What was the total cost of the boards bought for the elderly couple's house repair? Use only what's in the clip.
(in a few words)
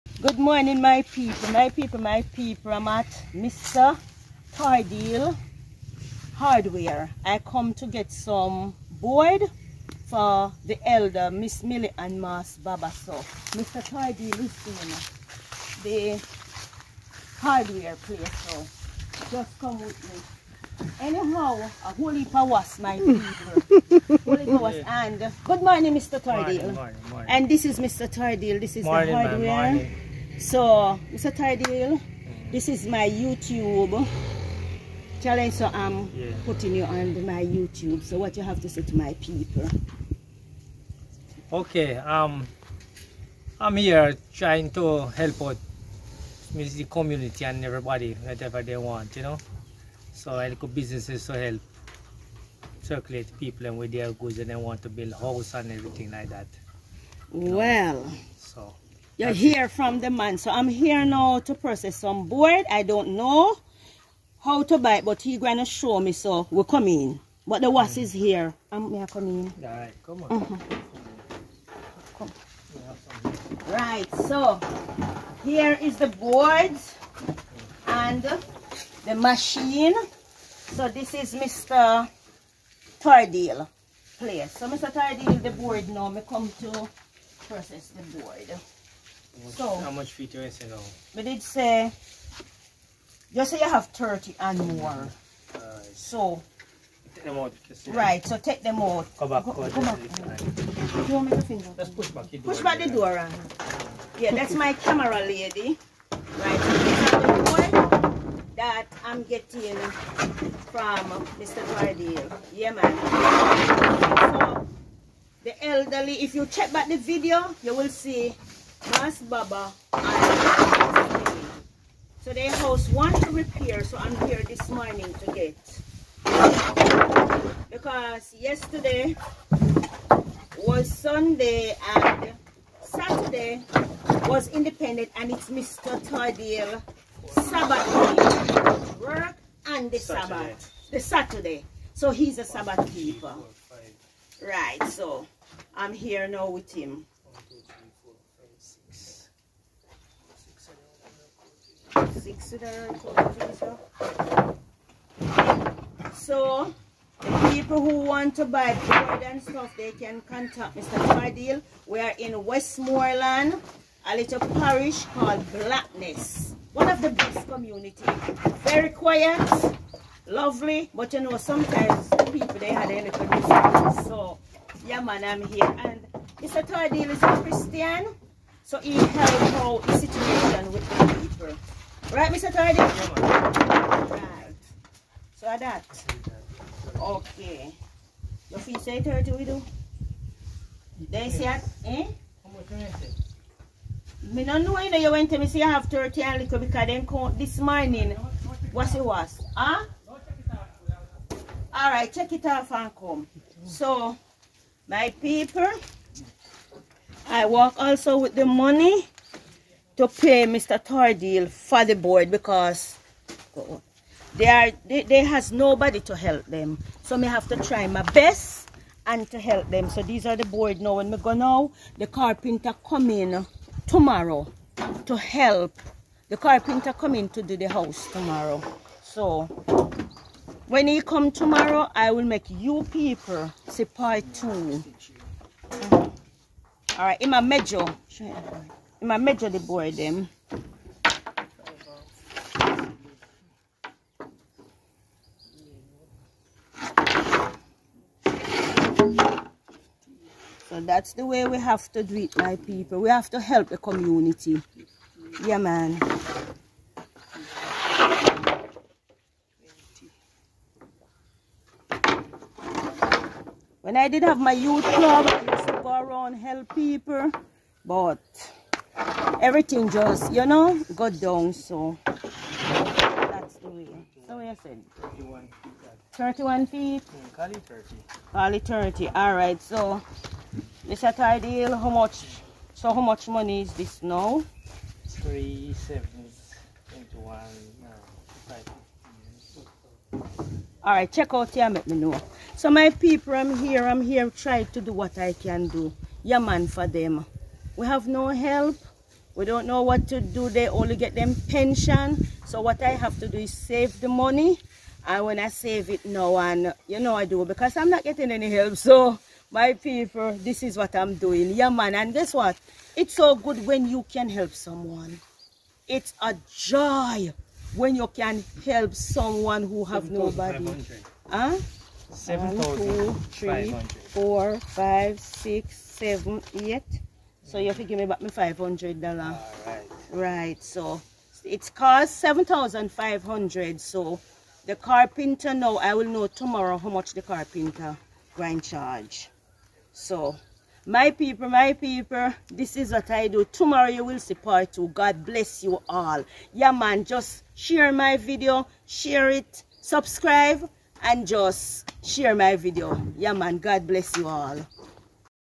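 7,500 dollars.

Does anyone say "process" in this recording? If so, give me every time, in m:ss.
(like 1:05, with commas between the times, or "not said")
1:01, 1:27.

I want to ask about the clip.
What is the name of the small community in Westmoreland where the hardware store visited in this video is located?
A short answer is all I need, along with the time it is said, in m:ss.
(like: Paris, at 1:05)
Blackness, at 2:45.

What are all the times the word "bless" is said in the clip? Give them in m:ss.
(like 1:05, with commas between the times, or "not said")
5:45, 5:53.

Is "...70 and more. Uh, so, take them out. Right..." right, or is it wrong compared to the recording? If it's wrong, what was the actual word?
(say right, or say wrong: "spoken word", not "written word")
wrong: "30", not "70".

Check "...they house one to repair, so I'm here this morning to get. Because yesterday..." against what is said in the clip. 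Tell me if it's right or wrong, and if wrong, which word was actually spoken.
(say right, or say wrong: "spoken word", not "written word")
right.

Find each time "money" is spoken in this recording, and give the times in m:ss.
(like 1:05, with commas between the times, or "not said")
3:28, 4:43, 5:04.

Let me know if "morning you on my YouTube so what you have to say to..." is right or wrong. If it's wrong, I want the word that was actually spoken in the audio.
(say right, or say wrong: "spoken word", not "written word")
wrong: "putting", not "morning".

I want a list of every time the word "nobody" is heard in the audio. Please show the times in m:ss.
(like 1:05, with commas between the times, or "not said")
3:35, 5:20.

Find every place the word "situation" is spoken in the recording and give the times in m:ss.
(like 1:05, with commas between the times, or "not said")
2:59.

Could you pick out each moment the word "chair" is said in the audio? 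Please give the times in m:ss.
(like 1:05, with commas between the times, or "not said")
not said.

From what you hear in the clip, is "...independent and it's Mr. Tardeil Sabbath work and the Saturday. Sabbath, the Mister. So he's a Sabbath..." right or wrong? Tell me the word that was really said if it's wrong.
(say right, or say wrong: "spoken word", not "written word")
wrong: "Saturday", not "Mister".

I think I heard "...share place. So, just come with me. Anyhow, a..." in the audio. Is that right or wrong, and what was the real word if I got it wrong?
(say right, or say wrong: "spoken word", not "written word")
wrong: "hardware", not "share".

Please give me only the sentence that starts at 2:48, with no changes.
Very quiet, lovely, but you know, sometimes people, they had a little So, yeah, man, I'm here.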